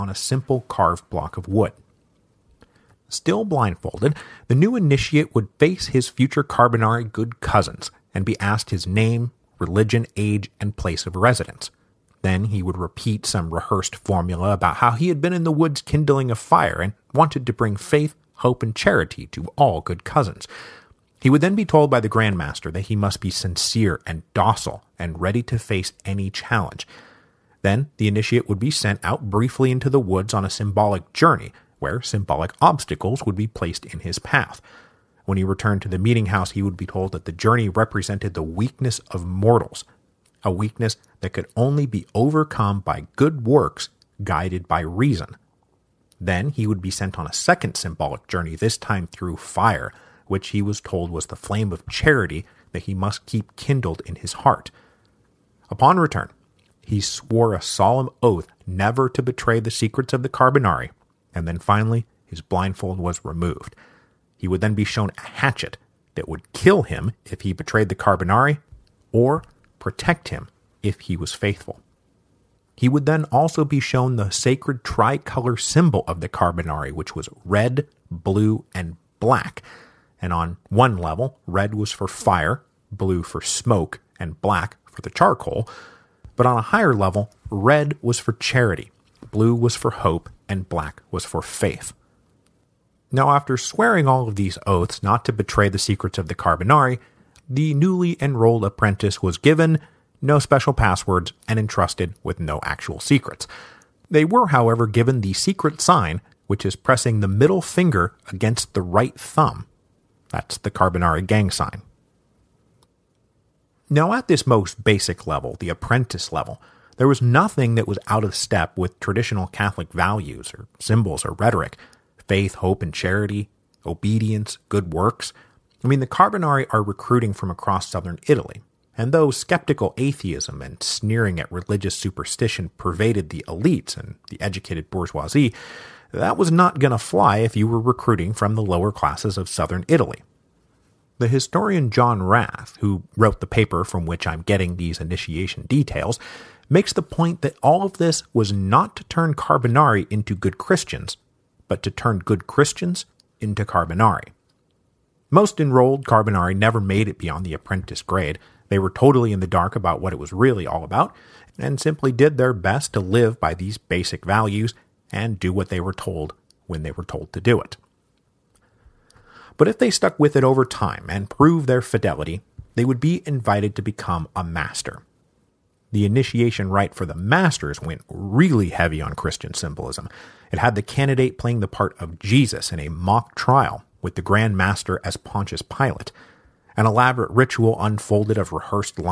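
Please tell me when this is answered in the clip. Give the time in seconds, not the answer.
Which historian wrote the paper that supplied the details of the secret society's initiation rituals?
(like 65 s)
141 s.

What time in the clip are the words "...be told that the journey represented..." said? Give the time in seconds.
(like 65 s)
36 s.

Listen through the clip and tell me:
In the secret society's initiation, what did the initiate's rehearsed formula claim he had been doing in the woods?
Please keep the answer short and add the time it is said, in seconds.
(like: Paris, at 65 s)
Kindling a fire, at 15 s.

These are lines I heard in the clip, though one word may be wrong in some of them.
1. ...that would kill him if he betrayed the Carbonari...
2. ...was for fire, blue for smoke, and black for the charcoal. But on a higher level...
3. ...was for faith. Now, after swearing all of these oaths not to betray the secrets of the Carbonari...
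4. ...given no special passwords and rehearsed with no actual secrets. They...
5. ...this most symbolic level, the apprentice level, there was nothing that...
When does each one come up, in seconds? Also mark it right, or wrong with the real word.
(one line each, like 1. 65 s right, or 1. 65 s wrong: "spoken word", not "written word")
1. 66 s right
2. 81 s right
3. 91 s right
4. 99 s wrong: "entrusted", not "rehearsed"
5. 114 s wrong: "basic", not "symbolic".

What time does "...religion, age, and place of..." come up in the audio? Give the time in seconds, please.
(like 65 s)
9 s.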